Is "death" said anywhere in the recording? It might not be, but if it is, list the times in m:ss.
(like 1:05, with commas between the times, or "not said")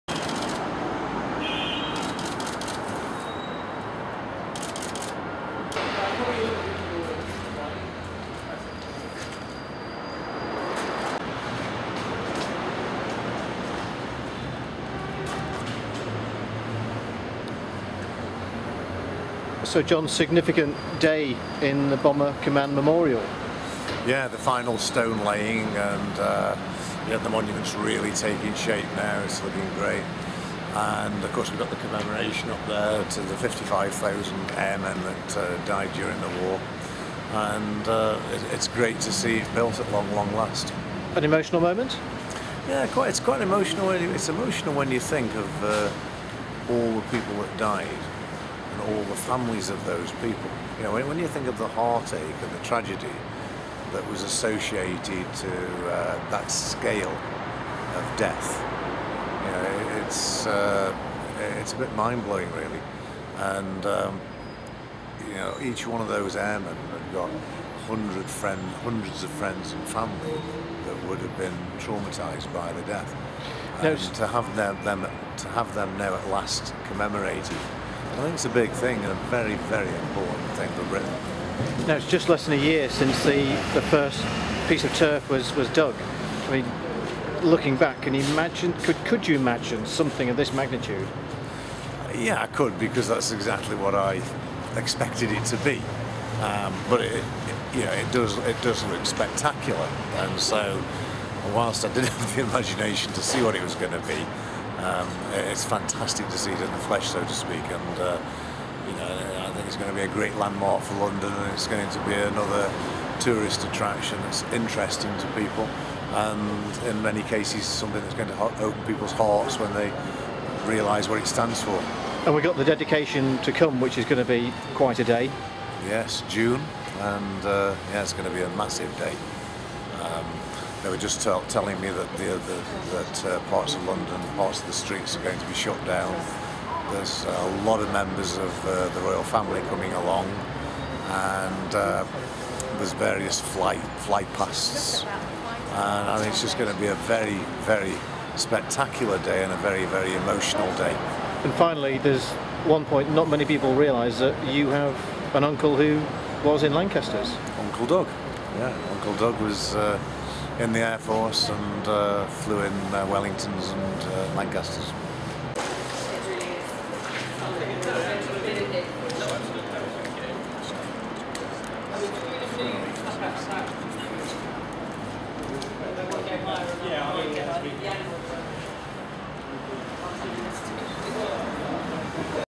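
0:58, 1:12.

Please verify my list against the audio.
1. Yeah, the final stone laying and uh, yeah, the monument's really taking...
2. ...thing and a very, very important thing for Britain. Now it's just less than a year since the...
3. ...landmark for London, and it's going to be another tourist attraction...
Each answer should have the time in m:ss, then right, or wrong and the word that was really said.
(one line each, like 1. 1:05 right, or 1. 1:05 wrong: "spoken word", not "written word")
1. 0:24 right
2. 1:18 right
3. 1:50 right.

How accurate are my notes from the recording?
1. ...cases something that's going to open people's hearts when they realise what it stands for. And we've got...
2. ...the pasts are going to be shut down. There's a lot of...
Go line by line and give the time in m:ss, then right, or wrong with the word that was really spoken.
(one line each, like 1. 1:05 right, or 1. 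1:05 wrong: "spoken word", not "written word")
1. 1:57 right
2. 2:14 wrong: "streets", not "pasts".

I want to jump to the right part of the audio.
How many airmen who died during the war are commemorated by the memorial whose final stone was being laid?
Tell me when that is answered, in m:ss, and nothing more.
0:33.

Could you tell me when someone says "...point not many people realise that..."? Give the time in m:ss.
2:32.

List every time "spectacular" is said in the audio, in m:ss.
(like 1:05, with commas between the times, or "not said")
1:39, 2:28.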